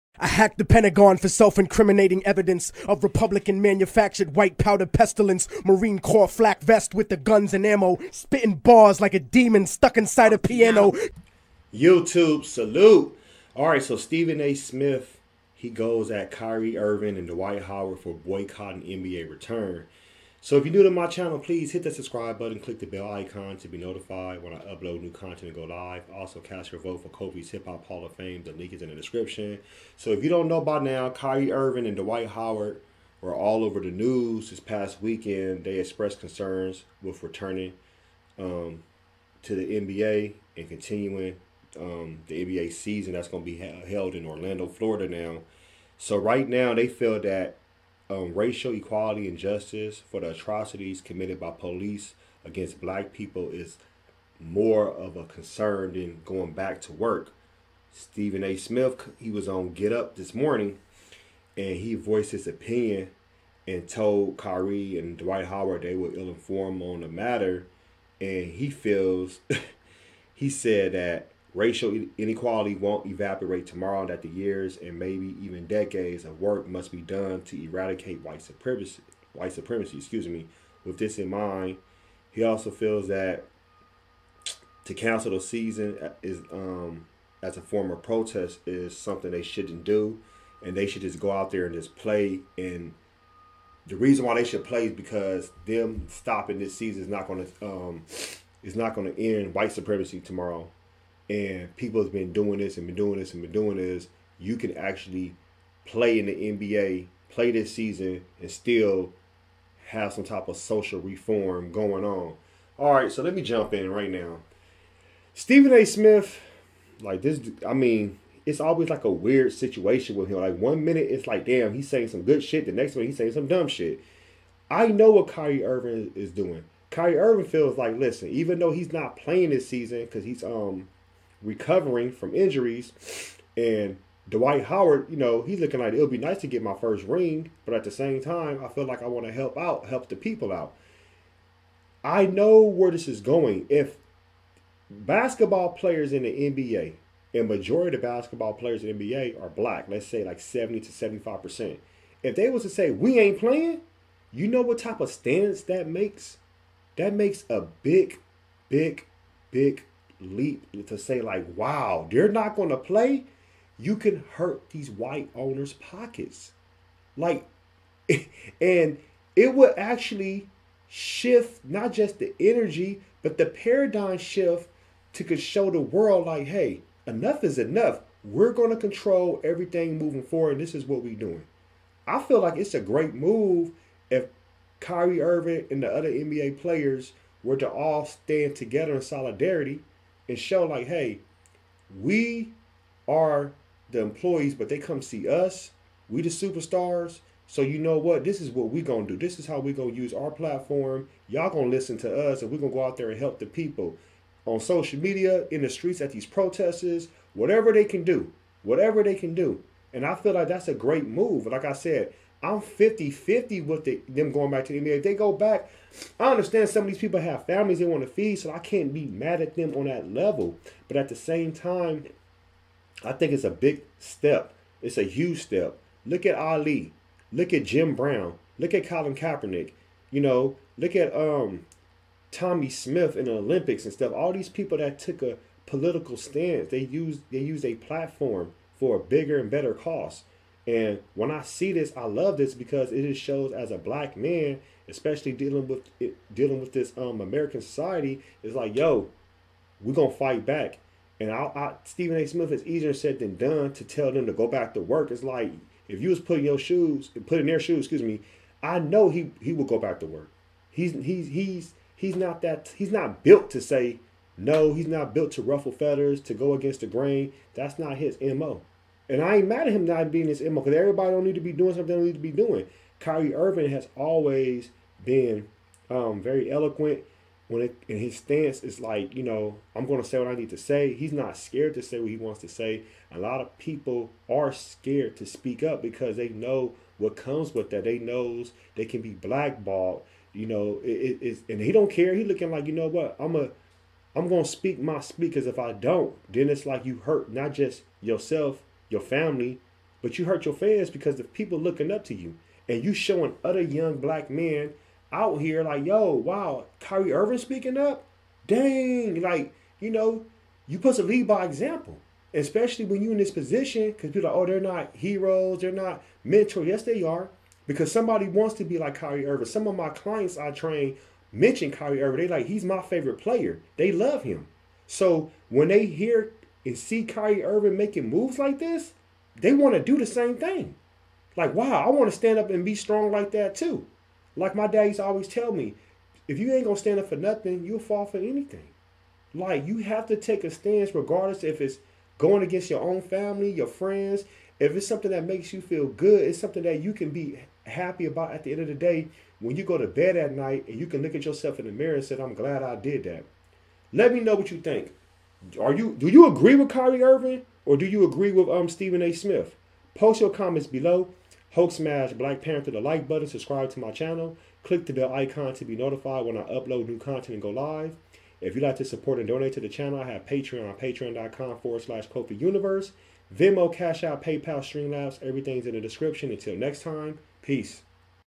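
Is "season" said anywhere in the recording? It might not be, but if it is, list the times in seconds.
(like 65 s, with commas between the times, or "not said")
42 s, 85 s, 96 s, 107 s, 129 s.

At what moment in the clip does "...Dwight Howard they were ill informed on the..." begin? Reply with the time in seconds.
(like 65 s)
65 s.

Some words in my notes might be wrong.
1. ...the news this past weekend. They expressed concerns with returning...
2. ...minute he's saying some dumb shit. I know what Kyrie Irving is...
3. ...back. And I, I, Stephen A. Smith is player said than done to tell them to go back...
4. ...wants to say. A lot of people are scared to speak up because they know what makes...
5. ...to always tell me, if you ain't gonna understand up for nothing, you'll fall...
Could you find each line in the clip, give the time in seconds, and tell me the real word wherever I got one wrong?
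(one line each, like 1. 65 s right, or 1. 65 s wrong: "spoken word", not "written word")
1. 33 s right
2. 122 s right
3. 250 s wrong: "easier", not "player"
4. 282 s wrong: "comes", not "makes"
5. 334 s wrong: "stand", not "understand".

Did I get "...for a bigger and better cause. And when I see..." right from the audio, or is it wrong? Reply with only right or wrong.
right.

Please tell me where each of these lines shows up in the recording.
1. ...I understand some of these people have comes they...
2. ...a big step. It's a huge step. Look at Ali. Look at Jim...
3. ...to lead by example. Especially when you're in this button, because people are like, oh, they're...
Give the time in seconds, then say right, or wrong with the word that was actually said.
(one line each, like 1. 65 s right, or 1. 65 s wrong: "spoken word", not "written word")
1. 216 s wrong: "families", not "comes"
2. 223 s right
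3. 310 s wrong: "position", not "button".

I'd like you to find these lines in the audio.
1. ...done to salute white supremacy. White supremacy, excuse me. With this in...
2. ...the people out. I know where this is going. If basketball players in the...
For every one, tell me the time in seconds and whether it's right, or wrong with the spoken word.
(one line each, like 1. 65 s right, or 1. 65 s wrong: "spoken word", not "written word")
1. 77 s wrong: "eradicate", not "salute"
2. 140 s right.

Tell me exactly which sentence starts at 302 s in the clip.
And you showing other young black men out here like, yo, wow, Kyrie Irving speaking up?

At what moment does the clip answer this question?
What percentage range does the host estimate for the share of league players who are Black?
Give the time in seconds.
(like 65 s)
150 s.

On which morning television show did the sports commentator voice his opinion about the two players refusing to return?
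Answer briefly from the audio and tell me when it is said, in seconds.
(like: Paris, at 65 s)
Get Up, at 59 s.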